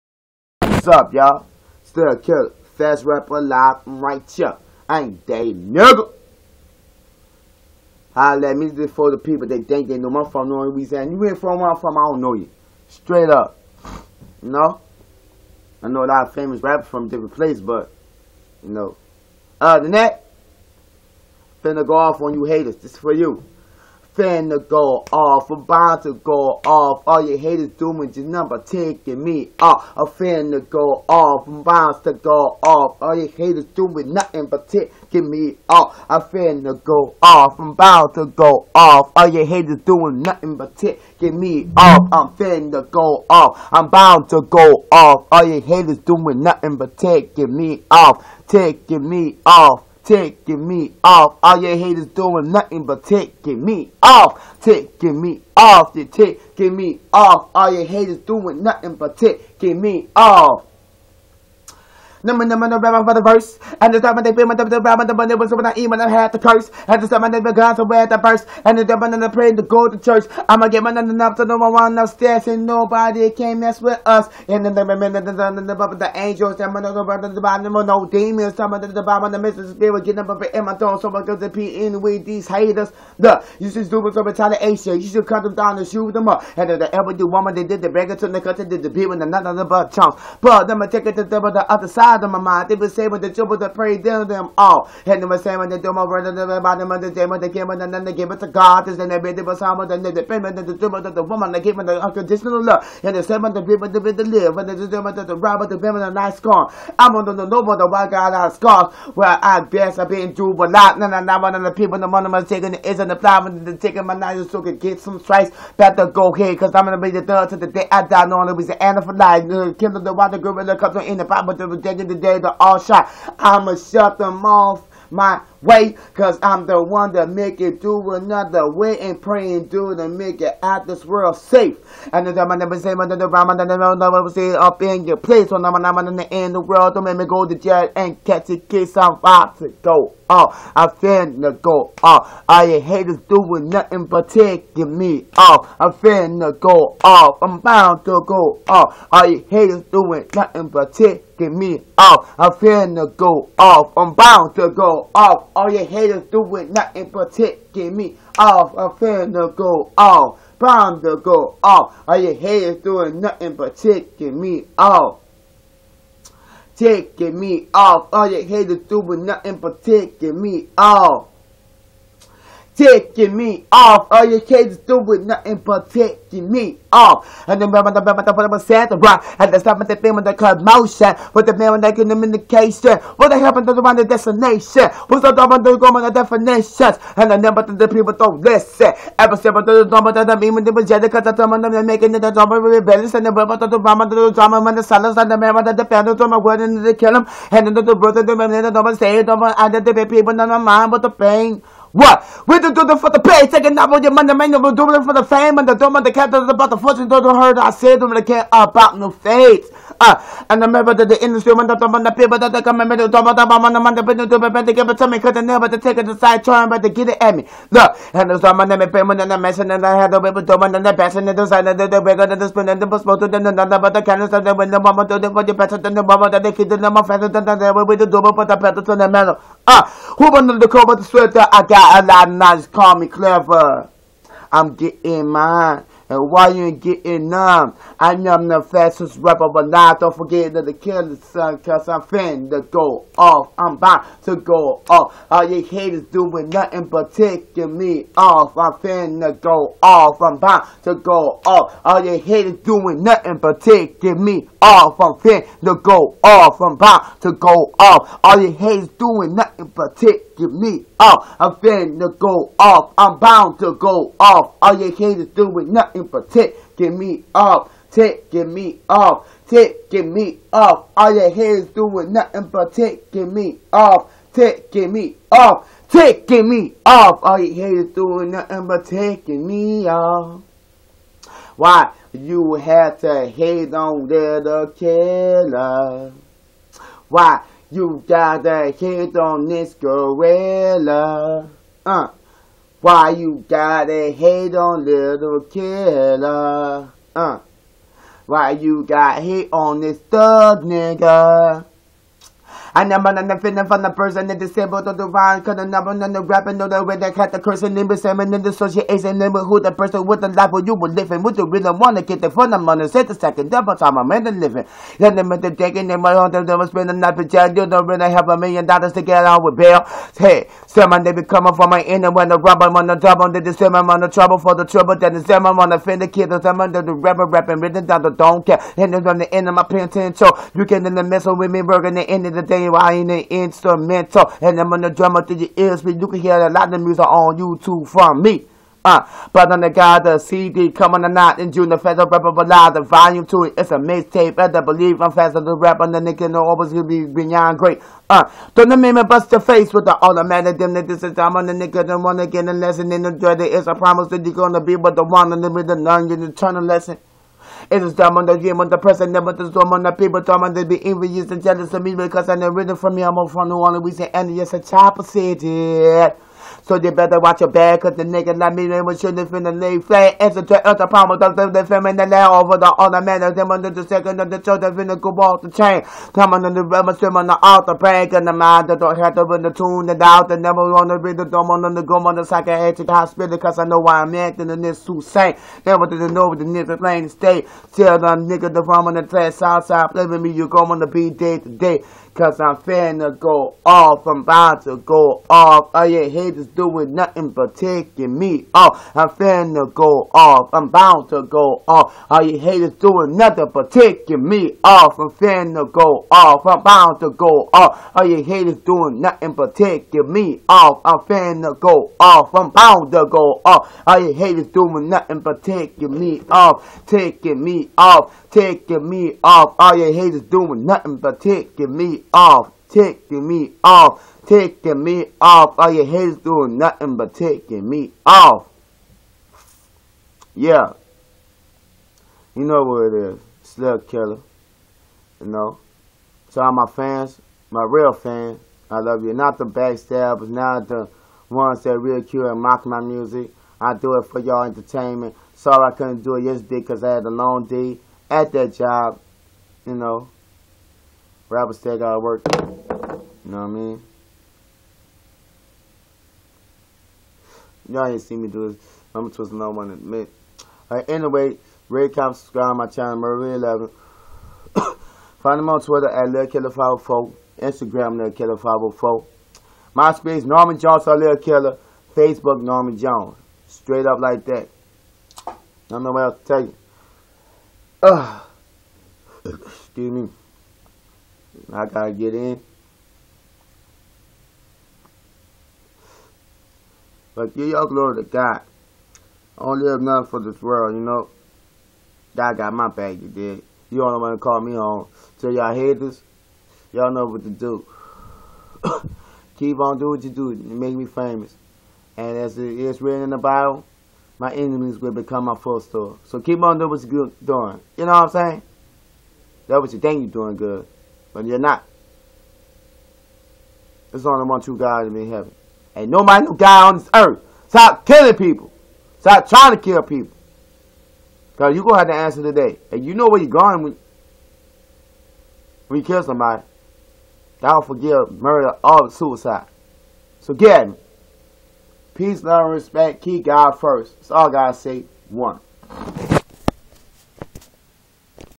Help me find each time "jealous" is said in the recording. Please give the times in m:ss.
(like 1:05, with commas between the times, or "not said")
6:01.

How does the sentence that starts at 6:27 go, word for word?
Tell the nigga the farm on the trash outside, play me, you are going to be dead today.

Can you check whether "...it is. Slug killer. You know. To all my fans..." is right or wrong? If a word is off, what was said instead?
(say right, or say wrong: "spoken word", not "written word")
right.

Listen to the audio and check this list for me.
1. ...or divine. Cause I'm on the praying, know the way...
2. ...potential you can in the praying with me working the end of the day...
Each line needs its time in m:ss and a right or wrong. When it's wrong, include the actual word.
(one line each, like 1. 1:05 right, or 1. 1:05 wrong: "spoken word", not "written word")
1. 5:04 wrong: "rapping", not "praying"
2. 5:29 wrong: "messing", not "praying".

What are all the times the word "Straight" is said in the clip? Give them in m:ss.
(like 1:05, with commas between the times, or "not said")
0:12, 7:53.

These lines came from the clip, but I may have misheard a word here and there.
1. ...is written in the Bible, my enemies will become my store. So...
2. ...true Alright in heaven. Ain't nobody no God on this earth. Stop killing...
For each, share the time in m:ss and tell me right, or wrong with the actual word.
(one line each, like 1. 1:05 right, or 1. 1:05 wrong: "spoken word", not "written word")
1. 8:22 right
2. 8:34 wrong: "God", not "Alright".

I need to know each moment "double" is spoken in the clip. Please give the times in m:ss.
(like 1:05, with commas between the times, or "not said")
1:04, 3:48, 5:13, 5:22.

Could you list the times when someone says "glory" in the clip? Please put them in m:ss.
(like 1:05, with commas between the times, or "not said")
8:07.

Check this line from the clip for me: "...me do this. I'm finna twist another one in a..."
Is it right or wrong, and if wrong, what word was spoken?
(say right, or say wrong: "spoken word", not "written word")
wrong: "gonna", not "finna".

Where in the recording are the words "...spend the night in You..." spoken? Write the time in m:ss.
5:16.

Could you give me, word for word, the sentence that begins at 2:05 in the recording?
My way because I'm the one that make it through another way and praying through to make it out this world safe.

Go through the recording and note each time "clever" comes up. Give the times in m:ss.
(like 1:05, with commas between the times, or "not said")
3:53.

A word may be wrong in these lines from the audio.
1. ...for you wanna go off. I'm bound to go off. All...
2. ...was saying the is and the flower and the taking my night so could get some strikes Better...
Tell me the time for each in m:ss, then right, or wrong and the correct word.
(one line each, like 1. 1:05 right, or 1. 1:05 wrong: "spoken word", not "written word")
1. 0:22 wrong: "finna", not "wanna"
2. 1:52 wrong: "taking", not "saying".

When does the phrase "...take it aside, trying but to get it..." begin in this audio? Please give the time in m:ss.
3:35.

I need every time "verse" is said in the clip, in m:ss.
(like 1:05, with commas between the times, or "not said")
1:03, 1:08.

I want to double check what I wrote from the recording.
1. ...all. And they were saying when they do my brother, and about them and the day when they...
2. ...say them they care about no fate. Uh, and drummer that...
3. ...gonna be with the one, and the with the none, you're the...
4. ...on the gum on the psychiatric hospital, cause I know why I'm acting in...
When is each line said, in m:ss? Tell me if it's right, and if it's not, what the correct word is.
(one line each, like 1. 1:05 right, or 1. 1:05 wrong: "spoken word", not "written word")
1. 1:34 right
2. 3:27 wrong: "remember", not "drummer"
3. 5:54 right
4. 6:21 right.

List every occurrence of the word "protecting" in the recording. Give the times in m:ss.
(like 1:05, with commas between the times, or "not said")
2:37, 2:43, 2:49.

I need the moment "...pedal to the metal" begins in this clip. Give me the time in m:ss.
3:48.